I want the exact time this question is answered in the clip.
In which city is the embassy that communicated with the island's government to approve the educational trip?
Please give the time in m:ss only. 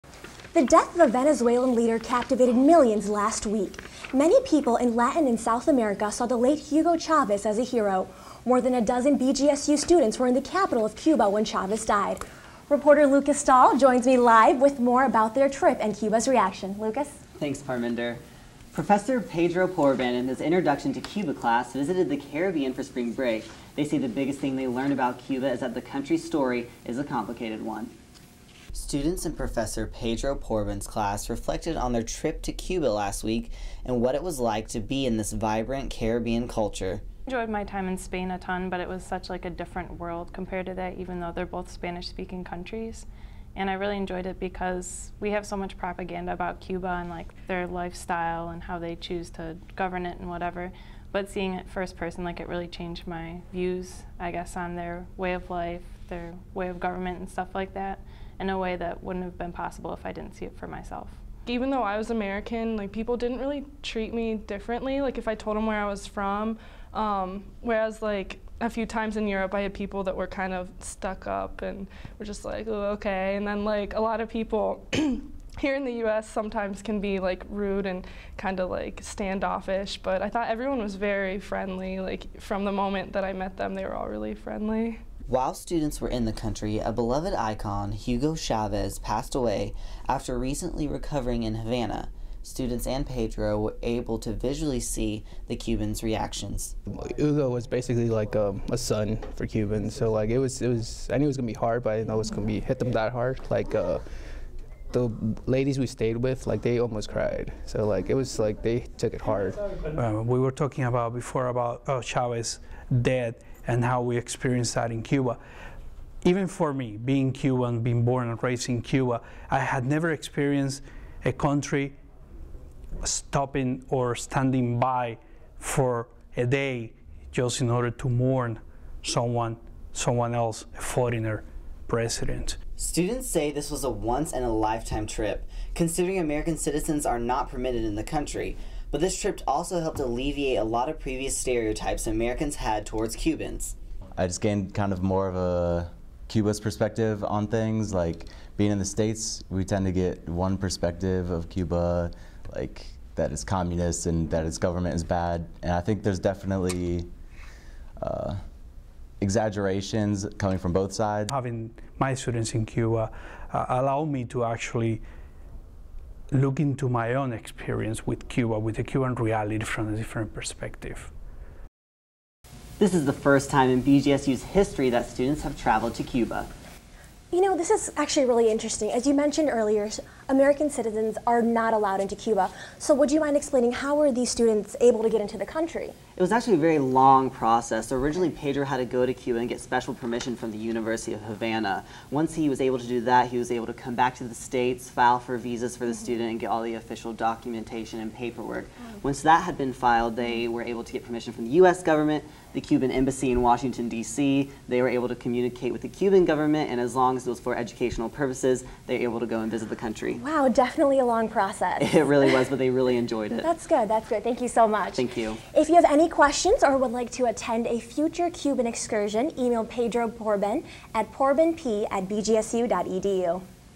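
3:23.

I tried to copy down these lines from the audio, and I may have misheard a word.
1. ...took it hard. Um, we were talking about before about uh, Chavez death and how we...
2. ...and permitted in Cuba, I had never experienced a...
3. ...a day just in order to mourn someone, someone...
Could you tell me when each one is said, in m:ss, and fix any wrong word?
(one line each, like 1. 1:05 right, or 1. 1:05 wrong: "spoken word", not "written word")
1. 1:48 right
2. 1:58 wrong: "raised", not "permitted"
3. 2:06 right.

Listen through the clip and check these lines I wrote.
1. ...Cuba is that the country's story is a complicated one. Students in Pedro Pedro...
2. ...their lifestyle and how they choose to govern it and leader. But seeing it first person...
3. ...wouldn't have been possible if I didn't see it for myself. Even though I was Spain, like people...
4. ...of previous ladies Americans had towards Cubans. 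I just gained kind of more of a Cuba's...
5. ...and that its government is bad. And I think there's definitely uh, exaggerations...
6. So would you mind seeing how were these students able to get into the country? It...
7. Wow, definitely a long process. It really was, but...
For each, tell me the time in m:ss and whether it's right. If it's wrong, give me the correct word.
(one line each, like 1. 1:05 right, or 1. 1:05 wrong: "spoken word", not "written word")
1. 0:25 wrong: "Professor", not "Pedro"
2. 0:47 wrong: "whatever", not "leader"
3. 0:59 wrong: "American", not "Spain"
4. 2:20 wrong: "stereotypes", not "ladies"
5. 2:34 right
6. 3:02 wrong: "explaining", not "seeing"
7. 3:30 right.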